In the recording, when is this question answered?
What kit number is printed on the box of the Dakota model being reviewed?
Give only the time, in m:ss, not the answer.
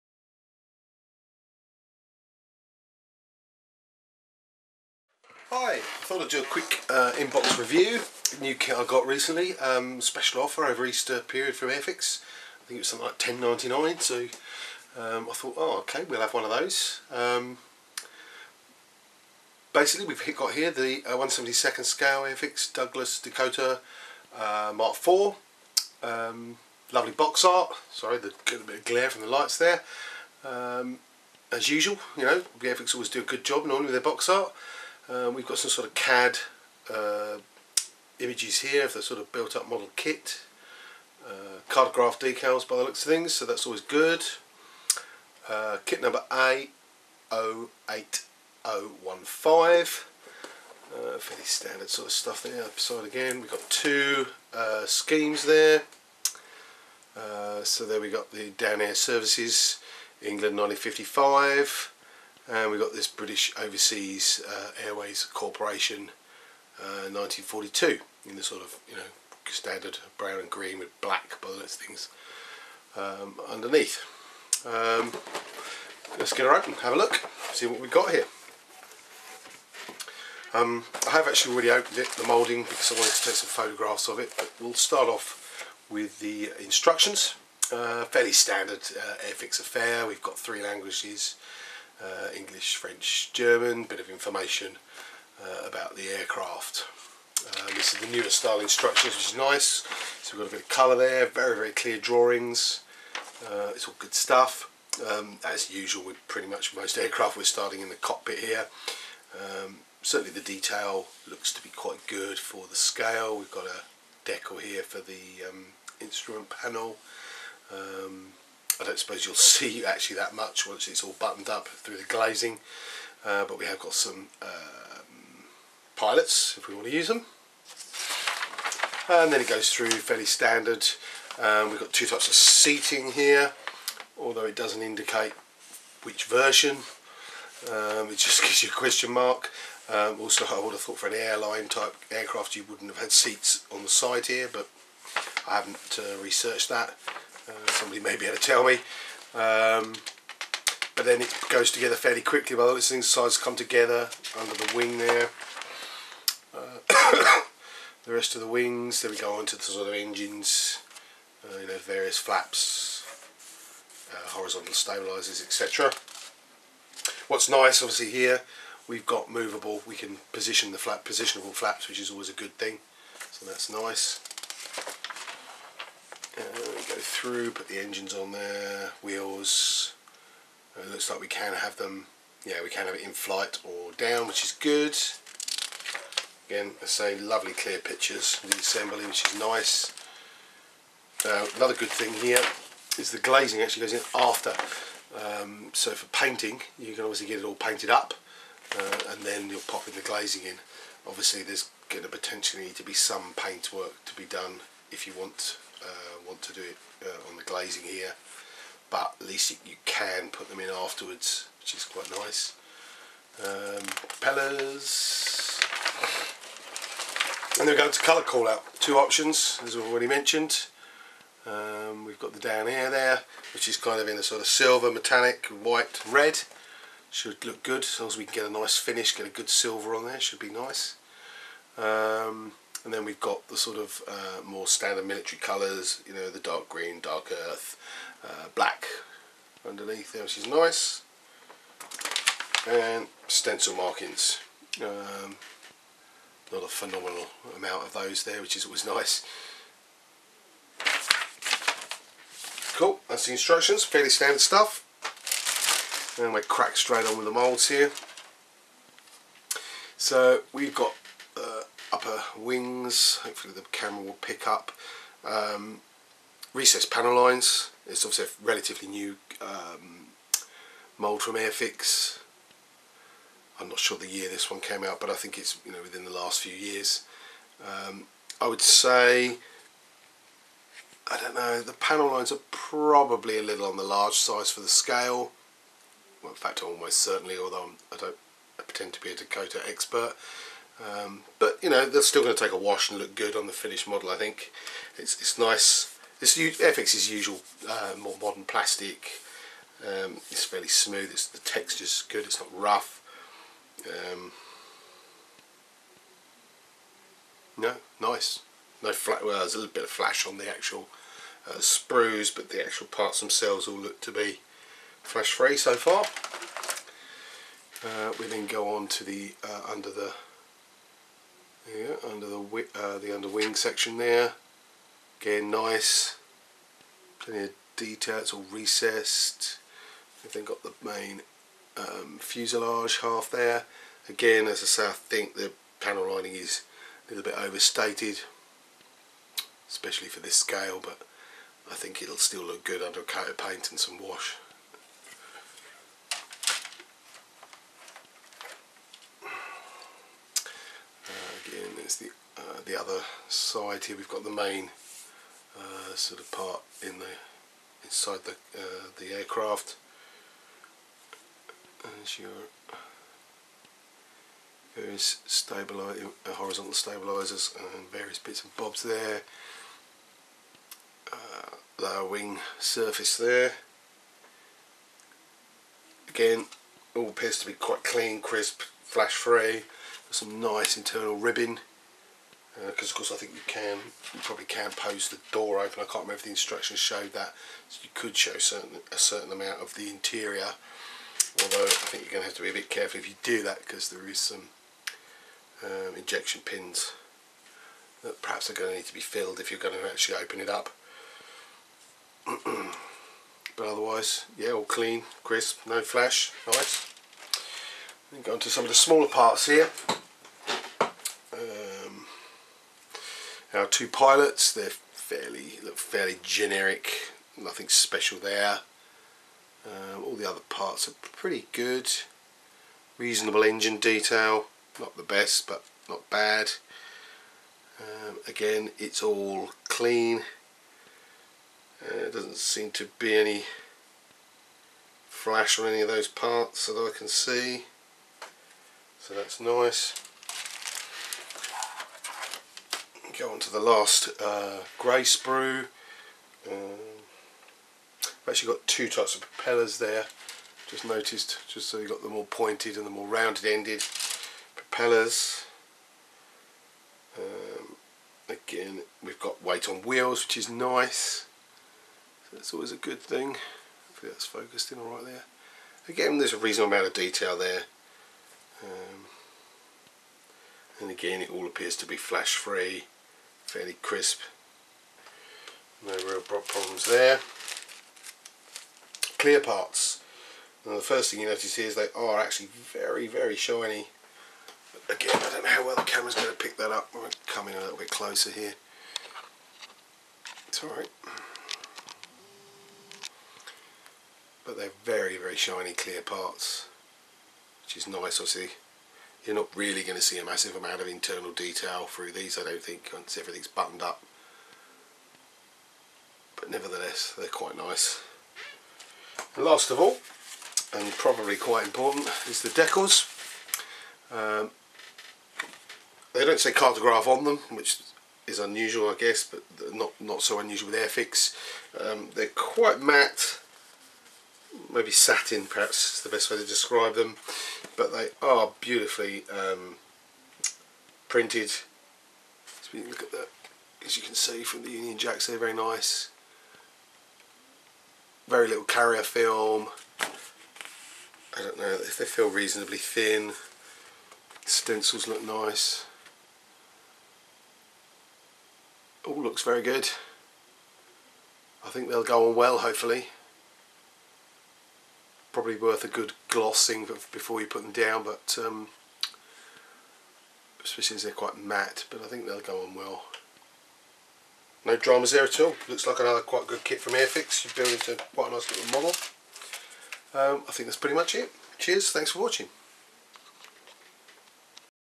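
0:46.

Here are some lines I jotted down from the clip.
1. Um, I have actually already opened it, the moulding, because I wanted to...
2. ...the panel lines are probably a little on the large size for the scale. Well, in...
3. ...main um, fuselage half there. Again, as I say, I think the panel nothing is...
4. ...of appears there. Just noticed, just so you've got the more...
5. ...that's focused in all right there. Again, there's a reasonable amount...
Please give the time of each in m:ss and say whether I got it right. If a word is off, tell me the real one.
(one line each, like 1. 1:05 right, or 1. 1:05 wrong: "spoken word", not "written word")
1. 1:20 right
2. 4:41 right
3. 5:30 wrong: "lining", not "nothing"
4. 7:29 wrong: "propellers", not "appears"
5. 7:44 right.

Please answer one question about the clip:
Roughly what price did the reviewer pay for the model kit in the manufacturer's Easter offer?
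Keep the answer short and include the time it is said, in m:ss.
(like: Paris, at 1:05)
10.99, at 0:13.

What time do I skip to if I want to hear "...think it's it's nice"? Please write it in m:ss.
4:54.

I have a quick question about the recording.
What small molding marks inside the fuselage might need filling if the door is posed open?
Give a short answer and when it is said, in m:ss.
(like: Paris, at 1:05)
Injection pins, at 6:35.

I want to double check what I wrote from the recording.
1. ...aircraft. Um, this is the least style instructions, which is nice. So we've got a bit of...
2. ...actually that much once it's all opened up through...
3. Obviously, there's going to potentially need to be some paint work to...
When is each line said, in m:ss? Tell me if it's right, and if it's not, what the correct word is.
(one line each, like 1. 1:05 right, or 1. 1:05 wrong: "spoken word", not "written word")
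1. 1:36 wrong: "newest", not "least"
2. 1:59 wrong: "buttoned", not "opened"
3. 3:21 right.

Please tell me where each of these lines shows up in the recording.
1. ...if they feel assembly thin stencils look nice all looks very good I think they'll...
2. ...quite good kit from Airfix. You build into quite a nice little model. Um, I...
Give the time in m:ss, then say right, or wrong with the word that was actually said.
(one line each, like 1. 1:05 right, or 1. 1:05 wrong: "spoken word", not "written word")
1. 9:01 wrong: "reasonably", not "assembly"
2. 9:26 right.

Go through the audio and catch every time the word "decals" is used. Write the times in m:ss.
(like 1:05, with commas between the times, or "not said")
0:41, 1:54, 8:32.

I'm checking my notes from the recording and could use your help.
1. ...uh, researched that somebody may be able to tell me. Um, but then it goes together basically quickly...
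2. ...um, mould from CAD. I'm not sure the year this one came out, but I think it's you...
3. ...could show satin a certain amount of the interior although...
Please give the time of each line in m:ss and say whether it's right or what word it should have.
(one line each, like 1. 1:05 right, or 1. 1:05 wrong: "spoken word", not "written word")
1. 2:26 wrong: "fairly", not "basically"
2. 4:29 wrong: "Airfix", not "CAD"
3. 6:27 wrong: "certain", not "satin".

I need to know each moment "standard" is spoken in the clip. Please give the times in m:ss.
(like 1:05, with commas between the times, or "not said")
0:51, 1:09, 1:28, 2:10, 3:54, 4:14.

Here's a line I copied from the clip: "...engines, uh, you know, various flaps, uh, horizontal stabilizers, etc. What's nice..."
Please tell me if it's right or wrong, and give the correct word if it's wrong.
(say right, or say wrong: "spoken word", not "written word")
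right.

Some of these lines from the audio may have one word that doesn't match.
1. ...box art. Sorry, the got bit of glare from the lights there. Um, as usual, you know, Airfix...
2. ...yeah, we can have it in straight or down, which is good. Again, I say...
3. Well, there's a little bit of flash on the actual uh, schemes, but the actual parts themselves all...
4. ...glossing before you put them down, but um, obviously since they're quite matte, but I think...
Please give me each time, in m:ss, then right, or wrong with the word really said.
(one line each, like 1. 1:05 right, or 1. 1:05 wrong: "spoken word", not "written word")
1. 0:27 right
2. 3:02 wrong: "flight", not "straight"
3. 5:09 wrong: "sprues", not "schemes"
4. 9:16 wrong: "especially", not "obviously".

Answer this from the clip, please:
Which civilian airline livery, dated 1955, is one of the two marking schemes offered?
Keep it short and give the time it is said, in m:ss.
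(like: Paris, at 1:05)
Dan-Air Services, at 0:58.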